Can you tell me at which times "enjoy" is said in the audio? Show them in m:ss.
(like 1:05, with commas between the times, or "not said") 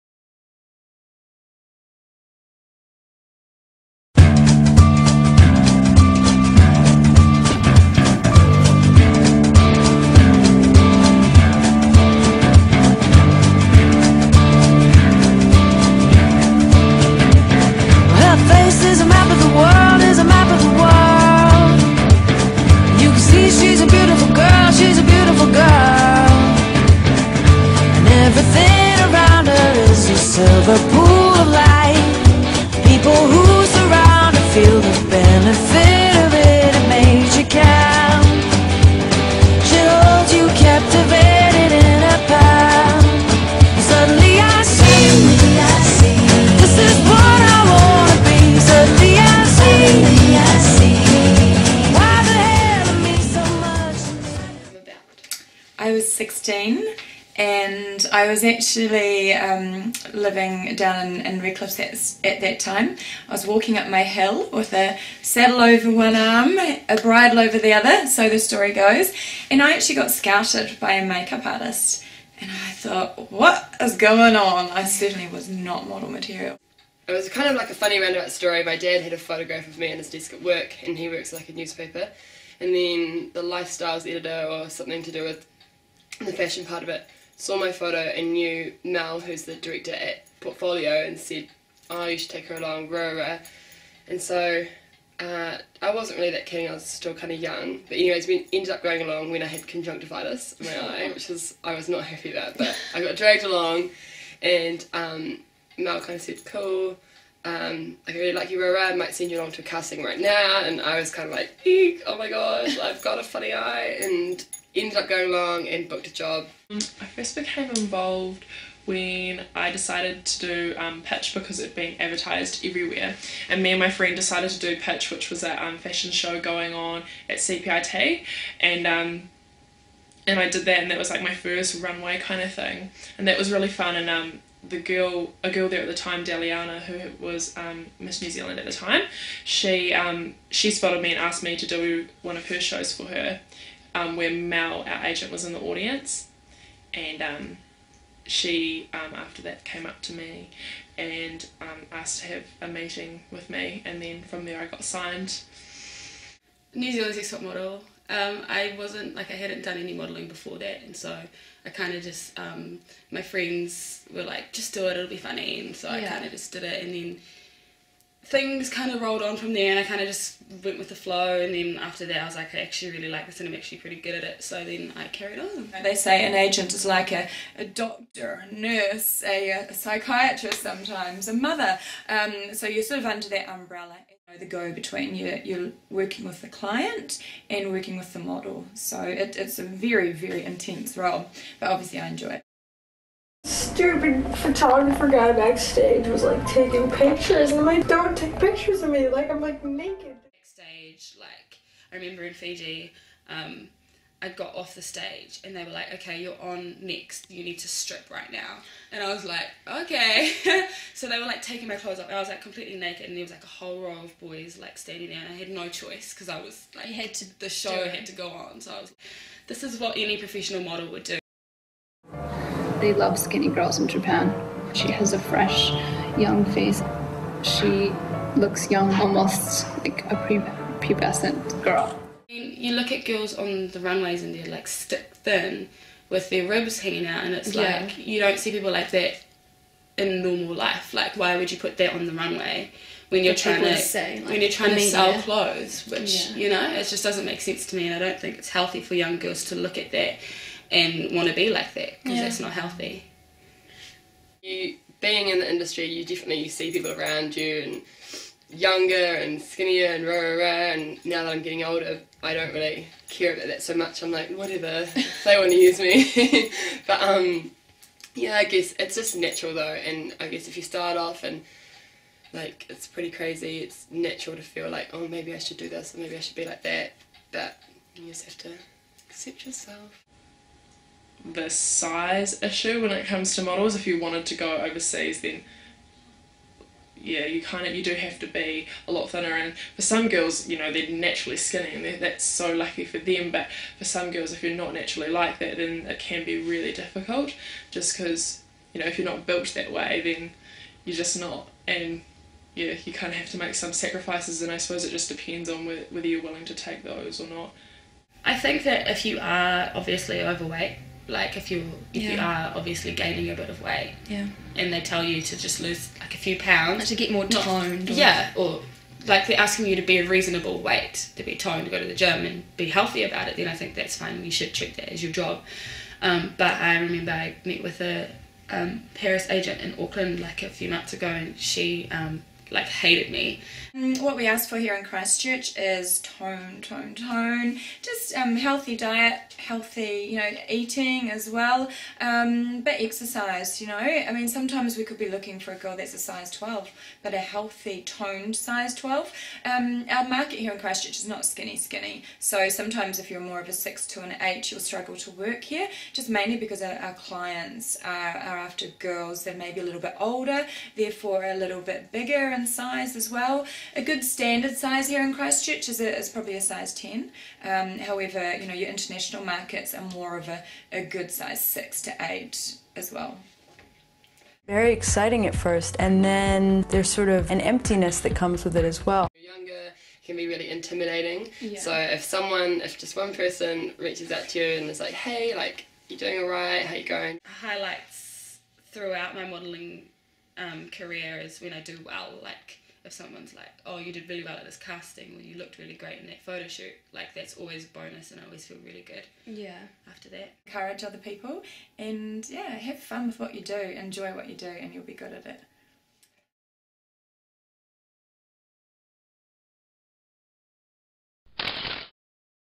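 3:12, 6:43.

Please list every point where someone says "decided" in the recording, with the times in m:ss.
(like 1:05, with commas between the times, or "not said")
1:59, 2:04.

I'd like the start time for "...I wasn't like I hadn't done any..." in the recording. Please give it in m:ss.
2:38.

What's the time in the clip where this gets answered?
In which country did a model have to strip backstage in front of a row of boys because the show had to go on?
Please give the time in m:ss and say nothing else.
3:22.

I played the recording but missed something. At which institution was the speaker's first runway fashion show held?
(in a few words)
CPIT.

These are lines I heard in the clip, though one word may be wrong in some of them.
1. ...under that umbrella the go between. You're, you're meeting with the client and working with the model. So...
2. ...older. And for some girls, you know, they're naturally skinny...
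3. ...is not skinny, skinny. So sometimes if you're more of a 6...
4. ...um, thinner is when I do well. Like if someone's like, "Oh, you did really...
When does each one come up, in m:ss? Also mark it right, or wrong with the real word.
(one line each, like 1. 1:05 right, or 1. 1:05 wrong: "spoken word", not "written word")
1. 3:03 wrong: "working", not "meeting"
2. 4:49 wrong: "thinner", not "older"
3. 5:50 right
4. 6:30 wrong: "career", not "thinner".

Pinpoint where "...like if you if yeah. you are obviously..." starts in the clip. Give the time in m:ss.
5:11.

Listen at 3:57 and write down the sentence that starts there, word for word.
like you don't see people like that in normal life.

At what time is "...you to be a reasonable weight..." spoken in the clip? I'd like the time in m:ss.
5:19.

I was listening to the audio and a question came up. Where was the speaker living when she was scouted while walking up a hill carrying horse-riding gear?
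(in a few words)
Redcliffe.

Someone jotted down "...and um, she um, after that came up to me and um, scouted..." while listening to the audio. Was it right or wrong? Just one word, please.
wrong.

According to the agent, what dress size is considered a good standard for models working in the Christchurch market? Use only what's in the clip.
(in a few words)
size 10.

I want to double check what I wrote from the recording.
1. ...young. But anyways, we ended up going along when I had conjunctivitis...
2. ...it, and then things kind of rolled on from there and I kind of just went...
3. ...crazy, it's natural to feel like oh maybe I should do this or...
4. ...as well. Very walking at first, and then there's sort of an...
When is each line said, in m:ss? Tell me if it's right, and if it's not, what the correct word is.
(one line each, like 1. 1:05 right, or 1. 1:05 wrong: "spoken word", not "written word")
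1. 1:37 right
2. 2:46 right
3. 4:33 right
4. 6:12 wrong: "exciting", not "walking".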